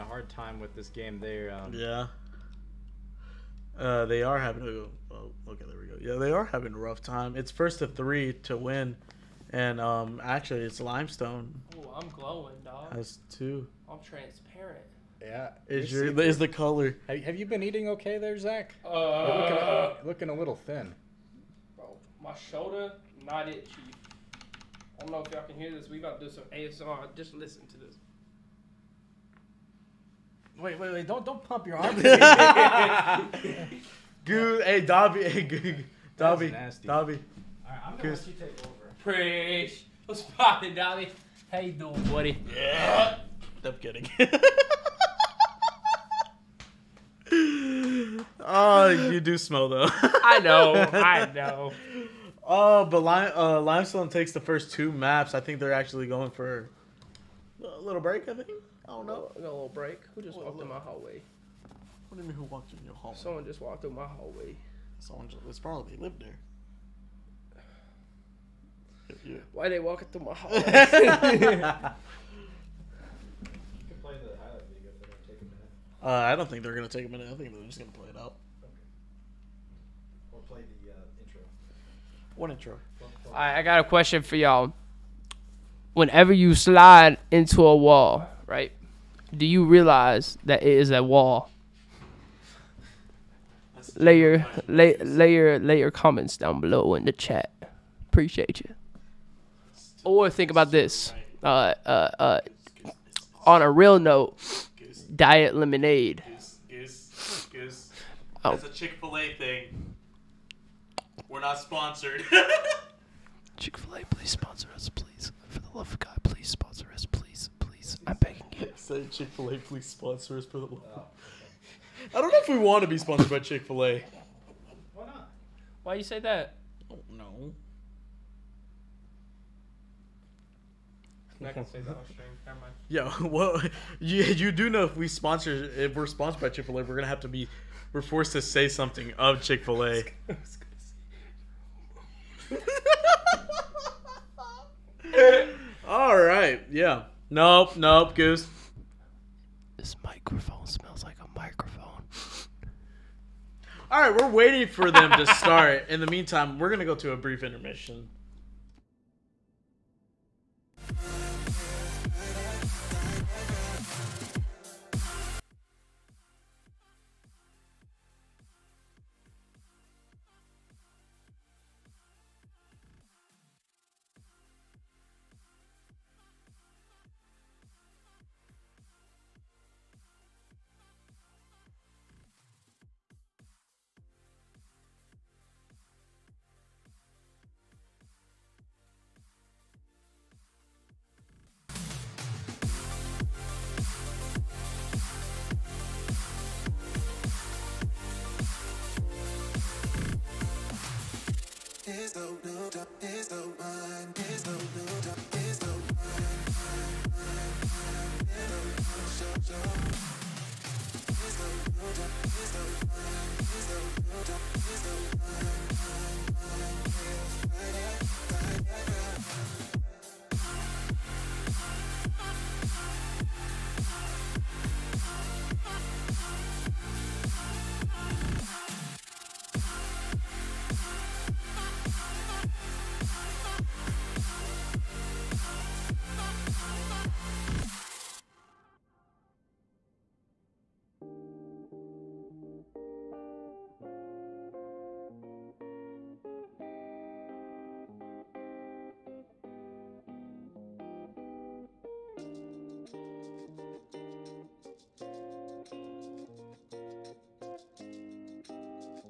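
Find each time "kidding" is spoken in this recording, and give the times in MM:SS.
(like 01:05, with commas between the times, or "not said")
00:43.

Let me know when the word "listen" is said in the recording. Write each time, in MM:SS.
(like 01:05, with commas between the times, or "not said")
00:27.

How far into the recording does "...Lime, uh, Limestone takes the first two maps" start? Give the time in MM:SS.
00:53.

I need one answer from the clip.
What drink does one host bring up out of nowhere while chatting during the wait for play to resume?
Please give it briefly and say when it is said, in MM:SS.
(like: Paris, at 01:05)
diet lemonade, at 01:45.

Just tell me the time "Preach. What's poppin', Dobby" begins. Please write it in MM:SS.
00:39.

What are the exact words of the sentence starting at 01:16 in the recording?
Uh, I don't think they're going to take a minute.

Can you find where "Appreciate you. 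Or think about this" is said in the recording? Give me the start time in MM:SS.
01:38.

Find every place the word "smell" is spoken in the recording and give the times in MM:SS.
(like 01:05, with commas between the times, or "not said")
00:49, 02:30.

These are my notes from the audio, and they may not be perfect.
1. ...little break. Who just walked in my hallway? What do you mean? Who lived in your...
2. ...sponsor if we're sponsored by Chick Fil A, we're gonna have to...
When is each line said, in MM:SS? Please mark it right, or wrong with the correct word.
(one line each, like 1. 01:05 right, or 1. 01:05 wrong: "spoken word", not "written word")
1. 00:59 wrong: "walked", not "lived"
2. 02:15 right.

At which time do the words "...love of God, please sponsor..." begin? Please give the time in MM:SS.
01:55.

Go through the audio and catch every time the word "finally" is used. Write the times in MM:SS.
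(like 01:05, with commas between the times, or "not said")
not said.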